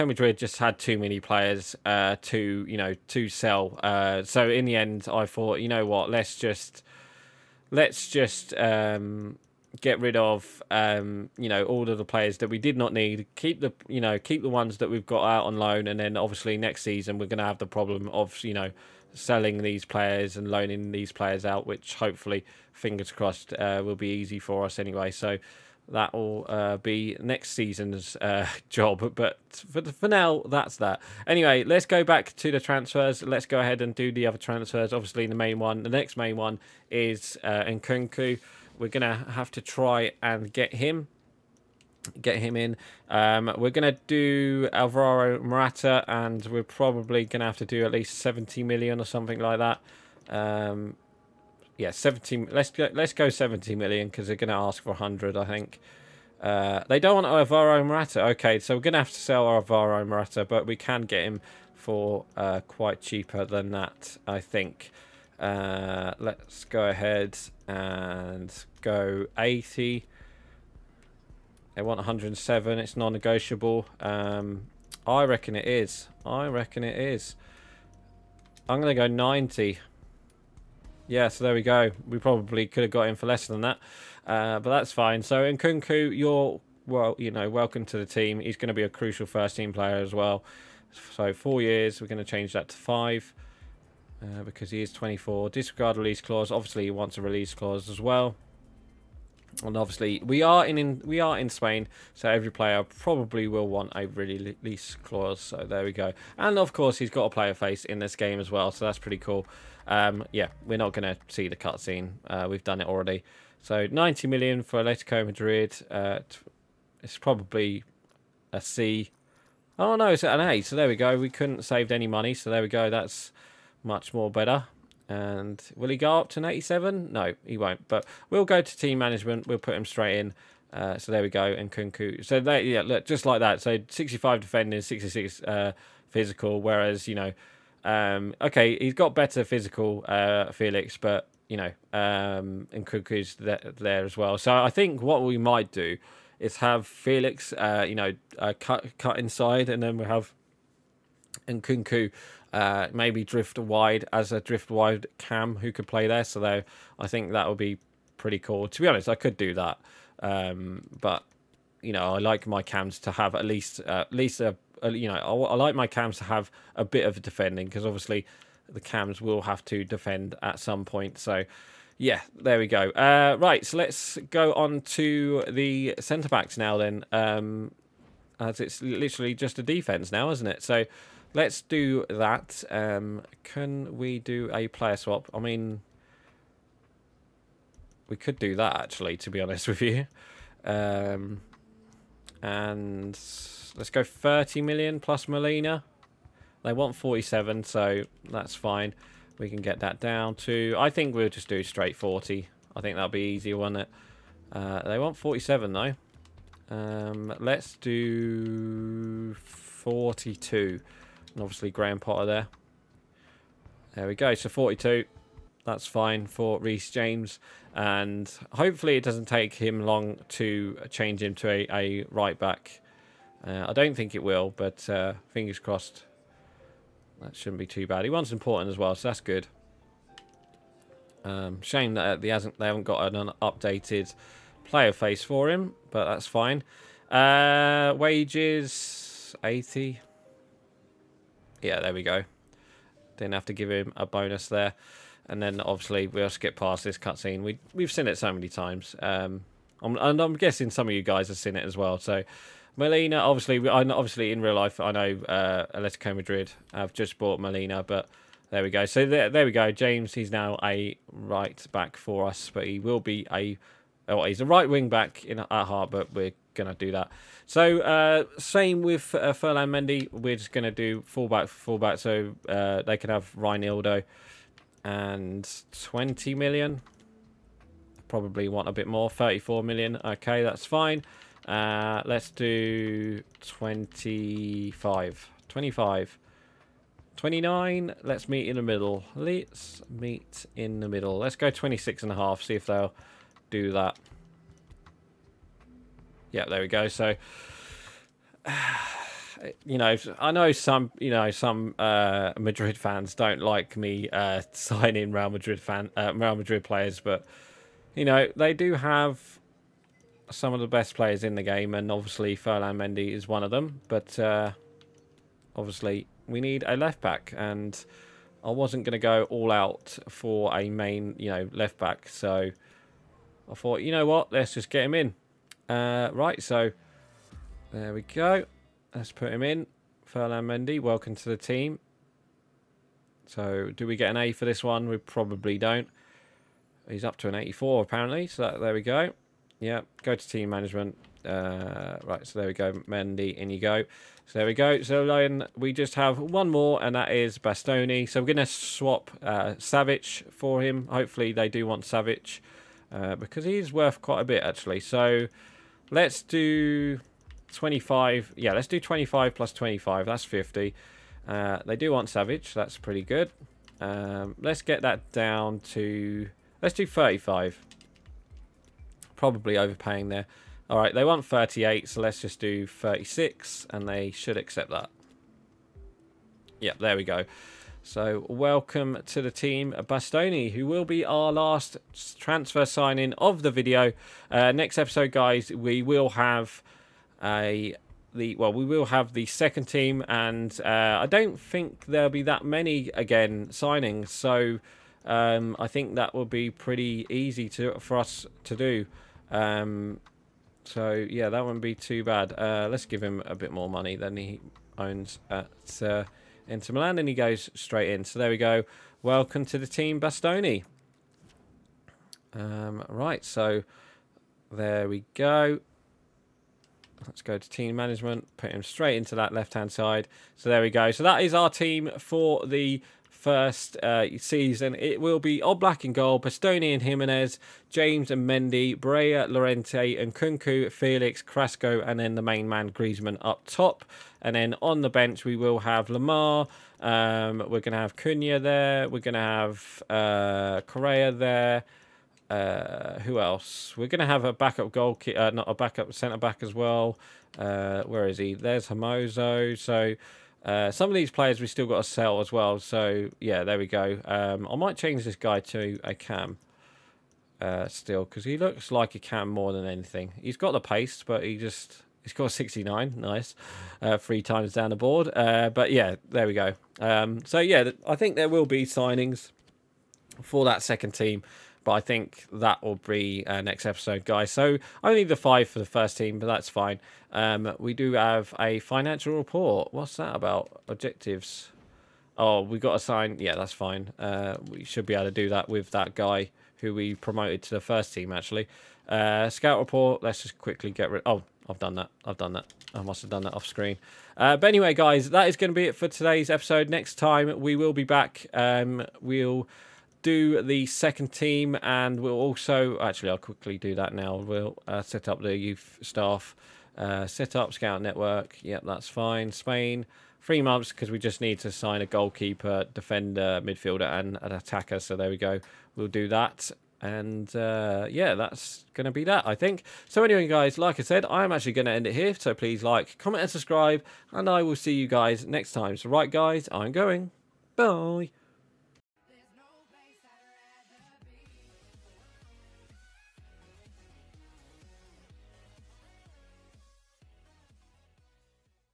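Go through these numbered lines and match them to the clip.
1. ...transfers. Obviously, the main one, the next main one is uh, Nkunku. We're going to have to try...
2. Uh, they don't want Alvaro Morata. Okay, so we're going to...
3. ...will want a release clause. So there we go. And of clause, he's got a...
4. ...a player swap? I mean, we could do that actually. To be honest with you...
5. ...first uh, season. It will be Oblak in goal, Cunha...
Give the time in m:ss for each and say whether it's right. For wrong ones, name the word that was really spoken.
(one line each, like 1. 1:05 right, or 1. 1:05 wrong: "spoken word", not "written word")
1. 0:34 right
2. 0:56 right
3. 1:43 wrong: "course", not "clause"
4. 3:04 right
5. 7:03 wrong: "Bastoni", not "Cunha".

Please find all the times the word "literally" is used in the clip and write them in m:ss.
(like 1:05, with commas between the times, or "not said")
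2:58.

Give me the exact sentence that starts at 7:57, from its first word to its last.
Um, we do have a financial report.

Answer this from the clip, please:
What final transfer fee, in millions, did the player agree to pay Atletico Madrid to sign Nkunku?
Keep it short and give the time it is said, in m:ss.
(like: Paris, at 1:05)
90 million, at 1:53.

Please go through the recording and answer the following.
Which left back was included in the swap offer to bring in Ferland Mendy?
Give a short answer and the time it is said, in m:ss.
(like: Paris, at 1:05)
Reinildo, at 4:33.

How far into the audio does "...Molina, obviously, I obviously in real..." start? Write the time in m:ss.
4:12.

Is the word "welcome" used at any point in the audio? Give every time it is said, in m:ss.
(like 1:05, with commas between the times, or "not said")
1:27, 5:30, 6:18, 6:49.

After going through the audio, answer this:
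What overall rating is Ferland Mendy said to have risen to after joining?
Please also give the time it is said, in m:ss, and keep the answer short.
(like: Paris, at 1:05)
84, at 5:37.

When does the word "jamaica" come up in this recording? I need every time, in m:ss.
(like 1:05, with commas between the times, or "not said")
not said.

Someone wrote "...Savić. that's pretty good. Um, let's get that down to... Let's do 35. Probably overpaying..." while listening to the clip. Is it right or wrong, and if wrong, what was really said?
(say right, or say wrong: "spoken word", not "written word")
right.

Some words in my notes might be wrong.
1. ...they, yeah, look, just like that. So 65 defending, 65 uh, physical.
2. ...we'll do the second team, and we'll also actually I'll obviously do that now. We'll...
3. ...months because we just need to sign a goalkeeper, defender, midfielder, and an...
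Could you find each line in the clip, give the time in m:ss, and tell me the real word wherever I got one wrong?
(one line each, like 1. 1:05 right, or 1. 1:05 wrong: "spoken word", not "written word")
1. 2:12 wrong: "66", not "65"
2. 8:18 wrong: "quickly", not "obviously"
3. 8:30 right.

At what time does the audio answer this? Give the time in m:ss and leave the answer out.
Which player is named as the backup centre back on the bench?
7:28.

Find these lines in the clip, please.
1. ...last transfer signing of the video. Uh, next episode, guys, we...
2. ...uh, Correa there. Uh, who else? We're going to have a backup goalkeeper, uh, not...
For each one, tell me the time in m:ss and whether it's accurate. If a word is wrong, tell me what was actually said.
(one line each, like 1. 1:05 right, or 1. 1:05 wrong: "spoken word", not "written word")
1. 6:21 right
2. 7:19 right.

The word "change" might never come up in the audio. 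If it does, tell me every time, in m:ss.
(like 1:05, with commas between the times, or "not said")
1:32, 3:40, 7:34.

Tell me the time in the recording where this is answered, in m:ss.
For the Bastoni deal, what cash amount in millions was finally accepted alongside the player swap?
6:12.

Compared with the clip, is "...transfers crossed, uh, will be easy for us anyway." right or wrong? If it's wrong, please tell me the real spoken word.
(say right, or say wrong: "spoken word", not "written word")
wrong: "fingers", not "transfers".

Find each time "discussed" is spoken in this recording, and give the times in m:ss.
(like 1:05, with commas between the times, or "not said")
not said.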